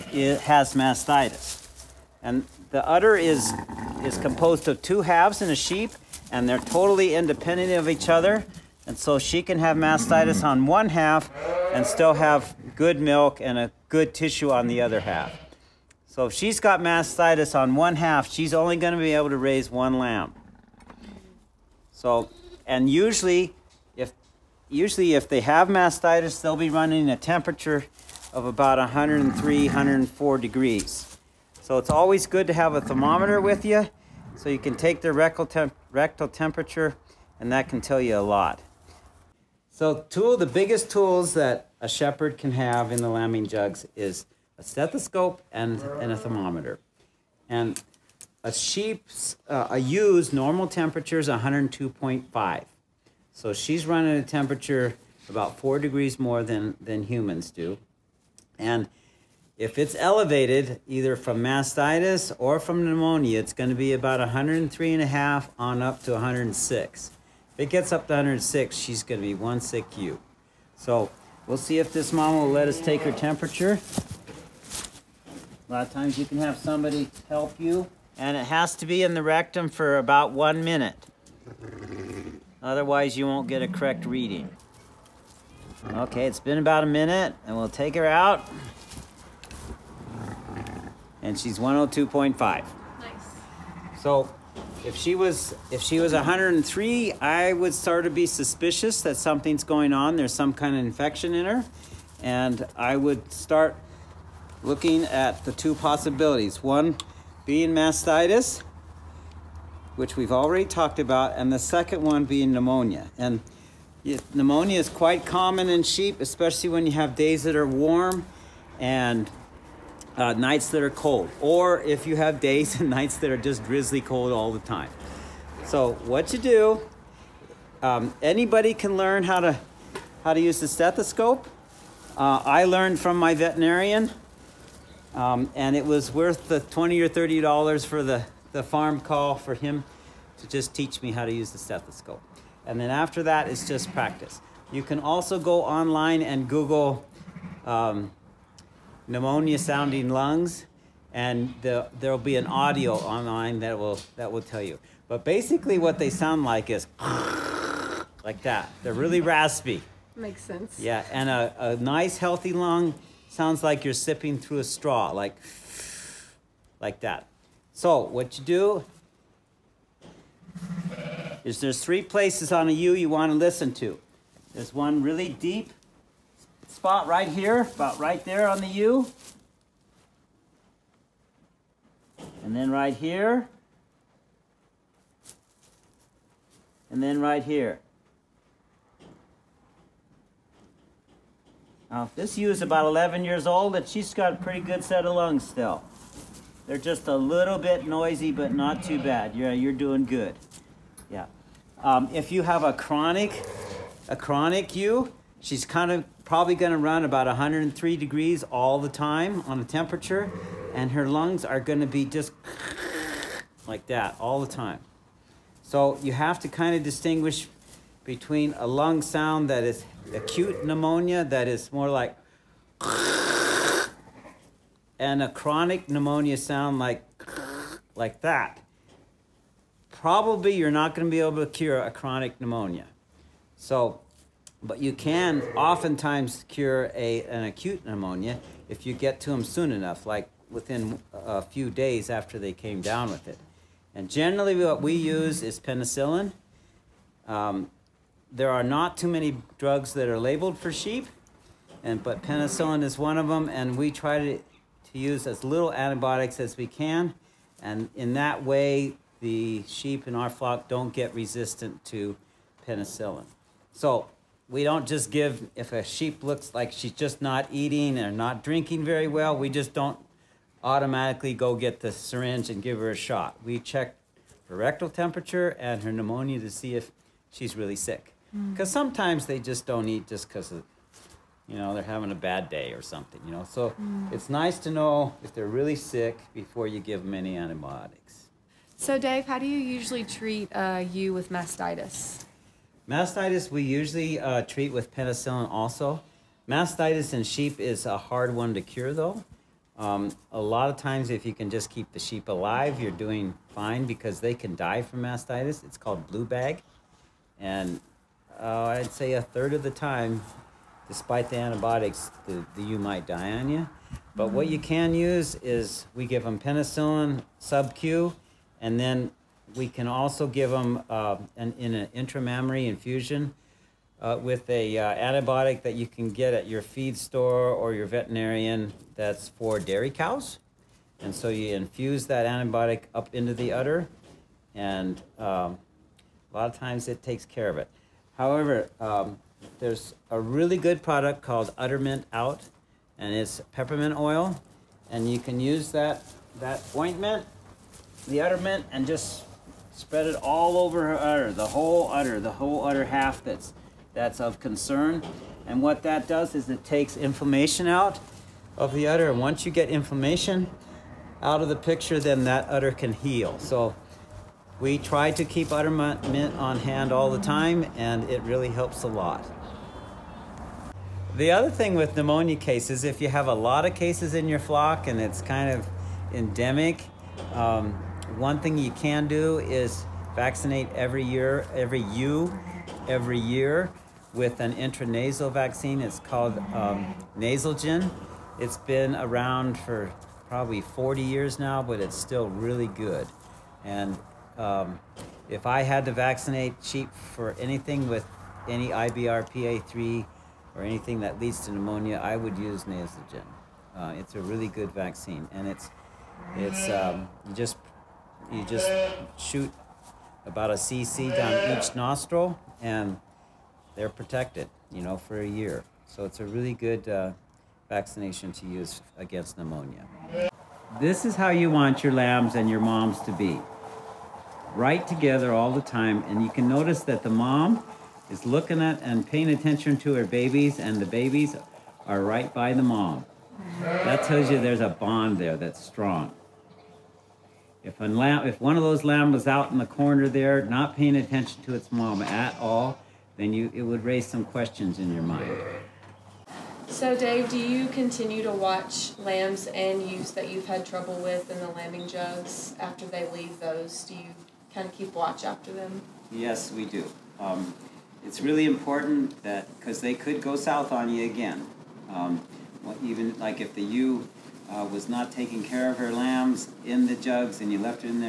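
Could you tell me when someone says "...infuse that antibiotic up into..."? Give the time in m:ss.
5:31.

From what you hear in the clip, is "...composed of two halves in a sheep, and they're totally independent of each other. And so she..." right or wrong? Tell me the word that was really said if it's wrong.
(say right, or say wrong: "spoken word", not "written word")
right.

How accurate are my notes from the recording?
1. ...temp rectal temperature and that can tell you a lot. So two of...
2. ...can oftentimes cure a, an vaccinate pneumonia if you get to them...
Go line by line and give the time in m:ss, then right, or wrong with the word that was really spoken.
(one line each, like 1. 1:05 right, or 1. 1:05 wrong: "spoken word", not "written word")
1. 0:35 right
2. 3:54 wrong: "acute", not "vaccinate".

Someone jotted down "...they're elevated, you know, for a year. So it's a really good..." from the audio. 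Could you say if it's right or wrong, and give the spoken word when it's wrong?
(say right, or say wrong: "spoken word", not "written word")
wrong: "protected", not "elevated".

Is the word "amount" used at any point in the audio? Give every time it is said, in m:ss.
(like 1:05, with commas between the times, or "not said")
not said.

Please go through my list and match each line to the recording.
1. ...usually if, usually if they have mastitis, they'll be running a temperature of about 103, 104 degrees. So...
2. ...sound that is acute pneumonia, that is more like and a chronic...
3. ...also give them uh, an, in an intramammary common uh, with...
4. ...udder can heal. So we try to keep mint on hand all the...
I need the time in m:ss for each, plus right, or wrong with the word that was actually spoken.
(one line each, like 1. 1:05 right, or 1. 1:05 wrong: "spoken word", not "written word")
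1. 0:22 right
2. 3:39 right
3. 5:19 wrong: "infusion", not "common"
4. 6:02 right.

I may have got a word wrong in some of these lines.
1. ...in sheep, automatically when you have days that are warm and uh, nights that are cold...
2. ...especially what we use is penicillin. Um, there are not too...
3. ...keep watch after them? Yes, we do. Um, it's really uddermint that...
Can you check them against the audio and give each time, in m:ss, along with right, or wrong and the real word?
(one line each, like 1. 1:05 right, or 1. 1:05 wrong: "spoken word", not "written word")
1. 1:55 wrong: "especially", not "automatically"
2. 4:04 wrong: "generally", not "especially"
3. 7:34 wrong: "important", not "uddermint".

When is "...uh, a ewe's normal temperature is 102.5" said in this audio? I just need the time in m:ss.
0:49.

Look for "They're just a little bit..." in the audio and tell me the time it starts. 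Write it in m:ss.
3:16.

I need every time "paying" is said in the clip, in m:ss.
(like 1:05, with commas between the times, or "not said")
7:09, 7:20.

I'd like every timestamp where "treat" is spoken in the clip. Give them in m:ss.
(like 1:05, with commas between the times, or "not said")
4:50, 4:54.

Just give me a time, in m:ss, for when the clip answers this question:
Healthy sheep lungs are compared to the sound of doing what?
2:43.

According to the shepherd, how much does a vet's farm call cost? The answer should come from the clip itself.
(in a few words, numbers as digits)
$20 or $30.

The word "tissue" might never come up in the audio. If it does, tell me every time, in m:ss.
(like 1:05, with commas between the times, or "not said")
0:14.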